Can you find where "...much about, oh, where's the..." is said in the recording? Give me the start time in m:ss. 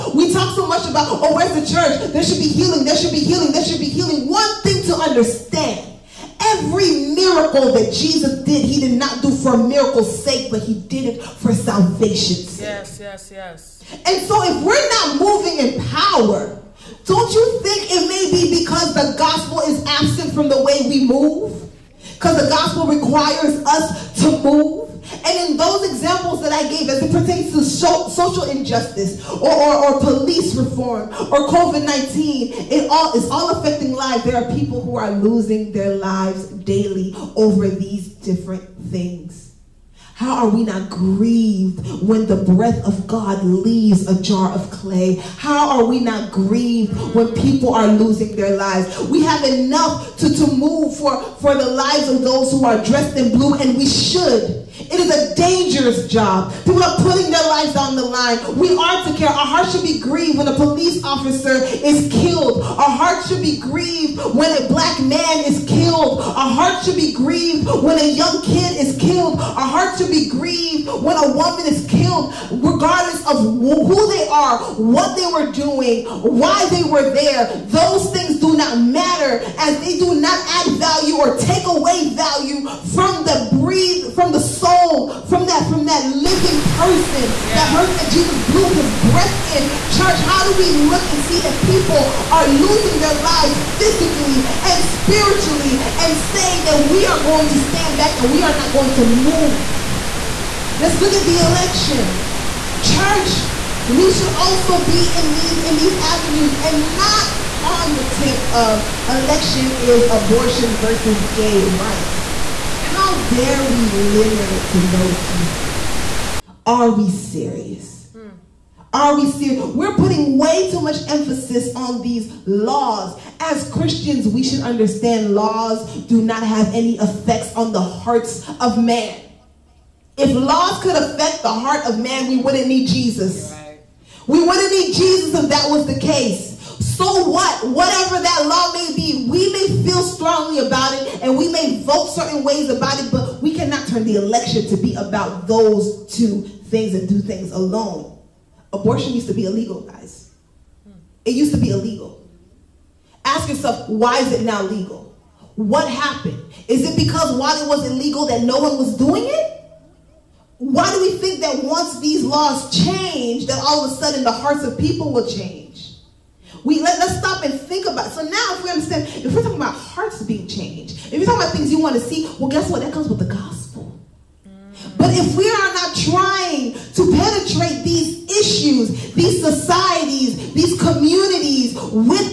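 0:00.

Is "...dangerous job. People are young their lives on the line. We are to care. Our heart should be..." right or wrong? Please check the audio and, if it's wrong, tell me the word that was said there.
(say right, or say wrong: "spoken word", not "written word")
wrong: "putting", not "young".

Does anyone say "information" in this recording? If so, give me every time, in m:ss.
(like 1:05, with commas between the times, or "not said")
not said.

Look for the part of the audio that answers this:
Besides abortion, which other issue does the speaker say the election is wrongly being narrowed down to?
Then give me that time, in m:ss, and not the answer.
1:51.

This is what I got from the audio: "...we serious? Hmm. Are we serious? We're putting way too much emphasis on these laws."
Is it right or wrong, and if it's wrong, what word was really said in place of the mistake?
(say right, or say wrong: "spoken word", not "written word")
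right.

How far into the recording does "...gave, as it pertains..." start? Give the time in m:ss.
0:26.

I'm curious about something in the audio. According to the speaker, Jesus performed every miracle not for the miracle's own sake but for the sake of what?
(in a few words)
Salvation.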